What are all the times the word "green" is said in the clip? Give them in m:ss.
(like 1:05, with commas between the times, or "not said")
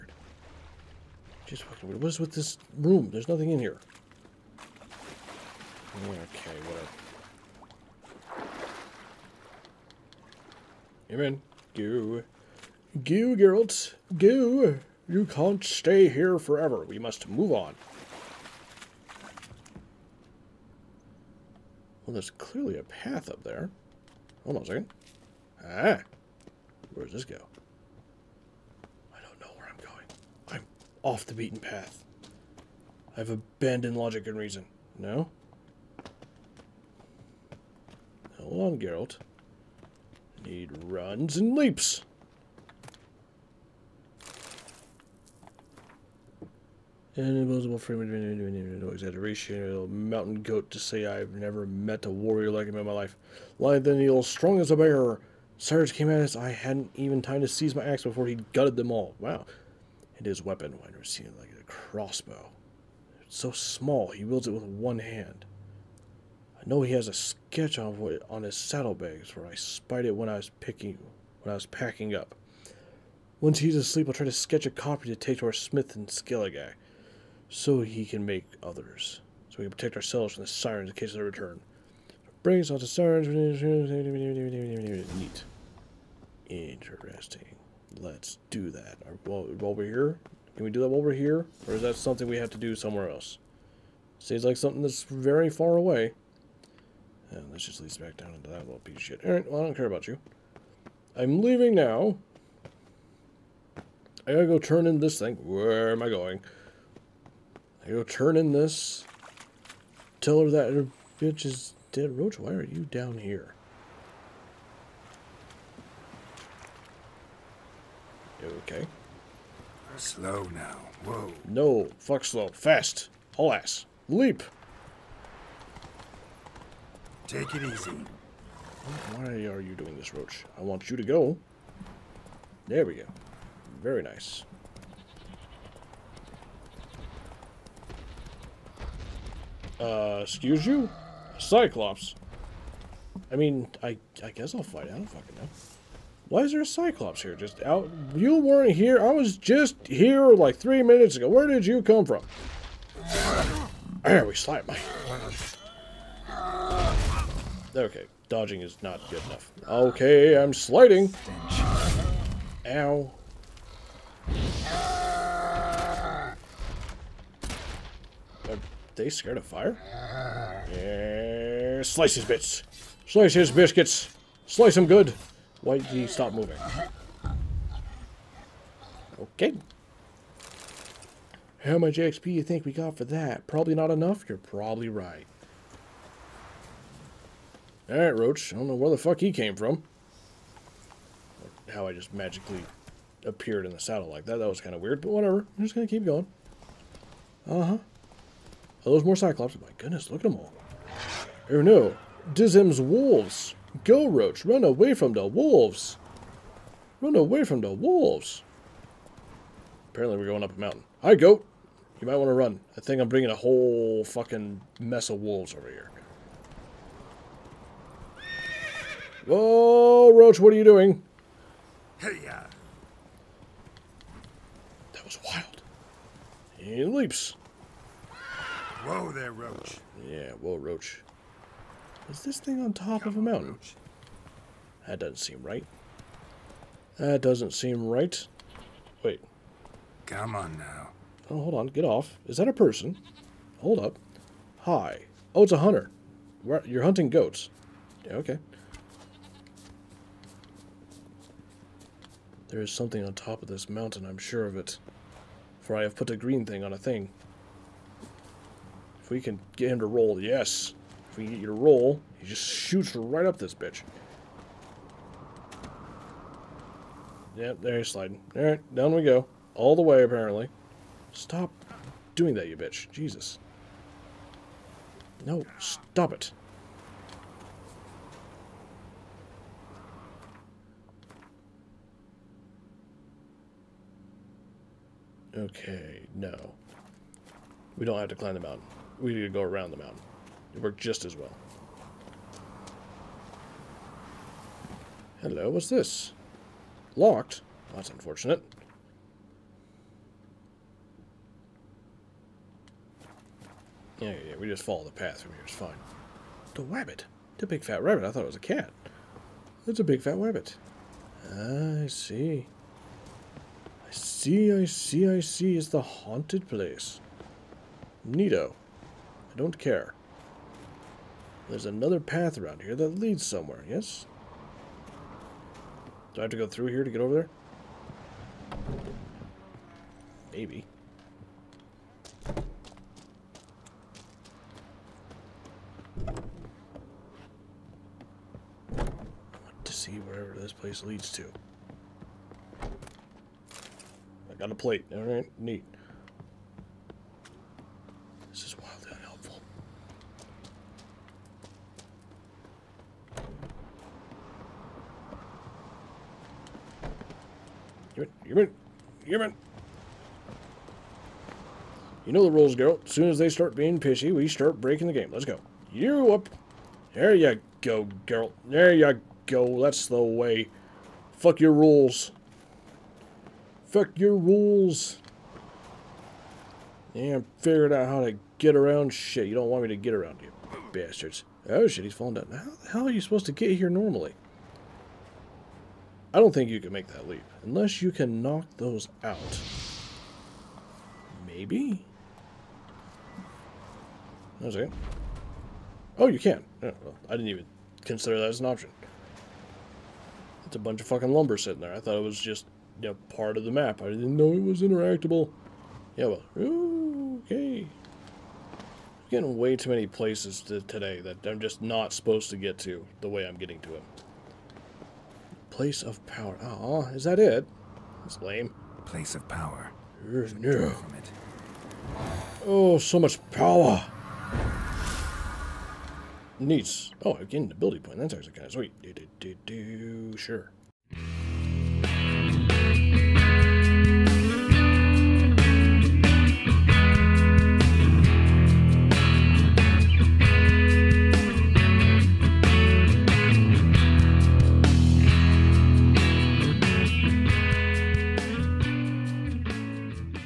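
4:16.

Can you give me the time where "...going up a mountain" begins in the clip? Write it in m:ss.
3:30.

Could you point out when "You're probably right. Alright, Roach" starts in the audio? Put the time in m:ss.
3:04.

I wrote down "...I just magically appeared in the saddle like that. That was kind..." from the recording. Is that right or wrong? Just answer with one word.
right.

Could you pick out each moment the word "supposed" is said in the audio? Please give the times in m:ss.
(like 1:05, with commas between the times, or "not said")
6:23, 6:51.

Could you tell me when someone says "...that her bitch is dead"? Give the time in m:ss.
1:50.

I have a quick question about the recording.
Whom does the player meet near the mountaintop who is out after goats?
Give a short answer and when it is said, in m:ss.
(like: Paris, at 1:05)
a hunter, at 4:05.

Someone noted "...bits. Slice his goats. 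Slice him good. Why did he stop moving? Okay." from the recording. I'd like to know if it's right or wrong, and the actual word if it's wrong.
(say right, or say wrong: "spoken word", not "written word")
wrong: "biscuits", not "goats".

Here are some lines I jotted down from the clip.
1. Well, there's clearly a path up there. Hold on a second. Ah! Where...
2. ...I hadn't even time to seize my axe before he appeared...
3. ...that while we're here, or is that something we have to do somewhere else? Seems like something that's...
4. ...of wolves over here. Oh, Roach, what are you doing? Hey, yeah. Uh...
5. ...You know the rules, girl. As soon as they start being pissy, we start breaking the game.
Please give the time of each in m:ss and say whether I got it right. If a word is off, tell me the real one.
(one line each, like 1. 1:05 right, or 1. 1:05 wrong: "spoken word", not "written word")
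1. 0:22 right
2. 0:56 wrong: "gutted", not "appeared"
3. 1:30 right
4. 3:35 right
5. 6:02 right.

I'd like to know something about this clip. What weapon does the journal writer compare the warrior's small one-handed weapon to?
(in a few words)
crossbow.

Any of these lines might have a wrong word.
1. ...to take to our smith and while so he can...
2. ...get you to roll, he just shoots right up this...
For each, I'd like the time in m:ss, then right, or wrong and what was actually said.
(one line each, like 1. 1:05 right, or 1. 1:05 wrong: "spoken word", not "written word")
1. 1:15 wrong: "scale", not "while"
2. 4:21 right.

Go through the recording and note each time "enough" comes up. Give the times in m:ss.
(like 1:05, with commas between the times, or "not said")
2:39, 3:03.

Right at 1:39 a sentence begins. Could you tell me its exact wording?
Alright, well, I don't care about you.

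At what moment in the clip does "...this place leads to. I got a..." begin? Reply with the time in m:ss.
5:40.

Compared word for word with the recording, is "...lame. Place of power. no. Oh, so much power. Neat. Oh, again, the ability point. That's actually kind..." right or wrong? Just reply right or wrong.
right.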